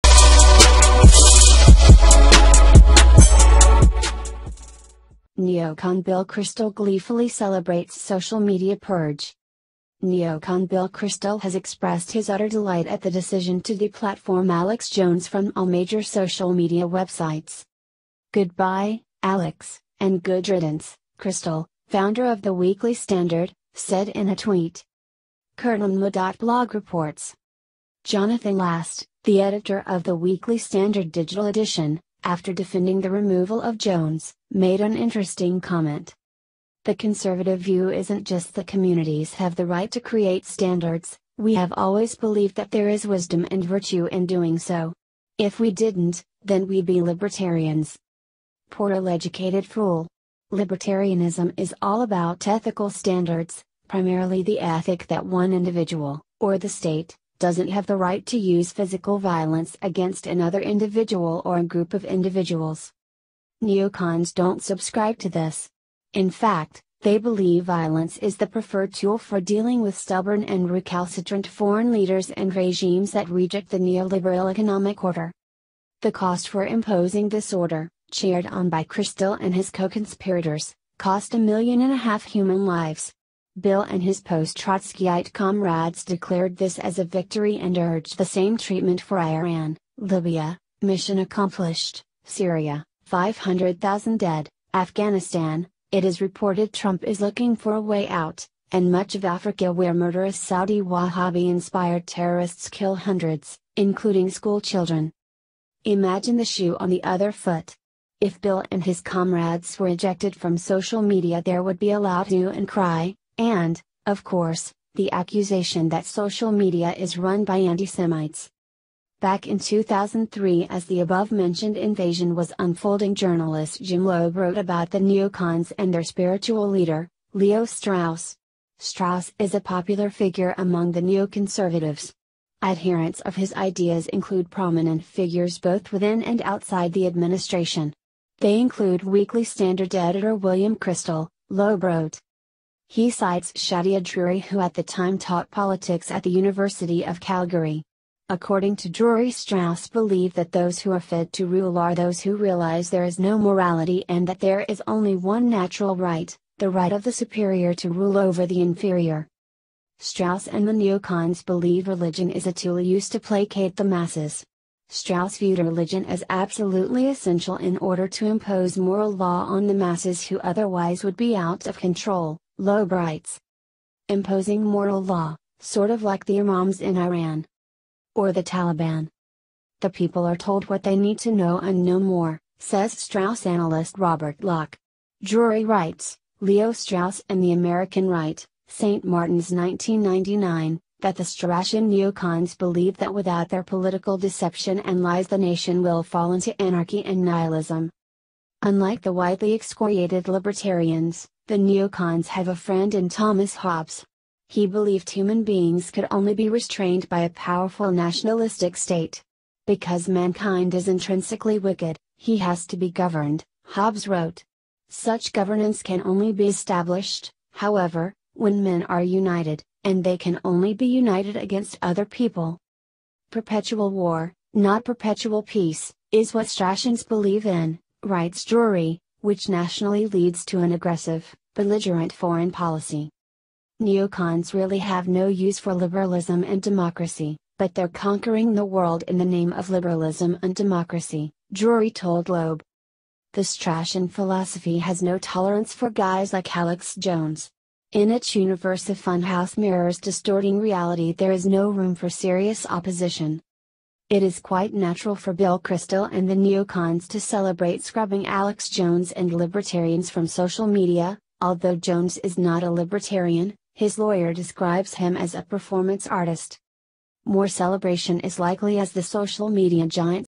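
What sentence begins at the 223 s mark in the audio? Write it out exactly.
Perpetual war, not perpetual peace, is what Straussians believe in, writes Drury, which nationally leads to an aggressive, belligerent foreign policy.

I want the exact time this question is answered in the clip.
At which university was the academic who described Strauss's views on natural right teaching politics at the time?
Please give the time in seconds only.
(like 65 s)
146 s.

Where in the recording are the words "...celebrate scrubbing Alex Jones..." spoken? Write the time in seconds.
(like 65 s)
257 s.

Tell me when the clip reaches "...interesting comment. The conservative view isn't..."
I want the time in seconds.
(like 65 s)
34 s.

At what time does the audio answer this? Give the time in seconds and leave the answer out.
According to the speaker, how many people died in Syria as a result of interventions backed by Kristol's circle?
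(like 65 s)
93 s.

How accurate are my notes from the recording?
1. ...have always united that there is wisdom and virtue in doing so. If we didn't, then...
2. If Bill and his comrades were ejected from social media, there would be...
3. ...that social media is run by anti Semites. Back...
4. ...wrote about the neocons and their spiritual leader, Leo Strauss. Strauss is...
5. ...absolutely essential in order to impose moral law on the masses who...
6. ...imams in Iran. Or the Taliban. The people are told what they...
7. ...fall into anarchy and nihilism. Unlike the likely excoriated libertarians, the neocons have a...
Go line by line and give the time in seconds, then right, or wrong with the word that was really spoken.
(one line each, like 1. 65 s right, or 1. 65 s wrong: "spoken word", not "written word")
1. 41 s wrong: "believed", not "united"
2. 108 s right
3. 115 s right
4. 124 s right
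5. 166 s right
6. 176 s right
7. 196 s wrong: "widely", not "likely".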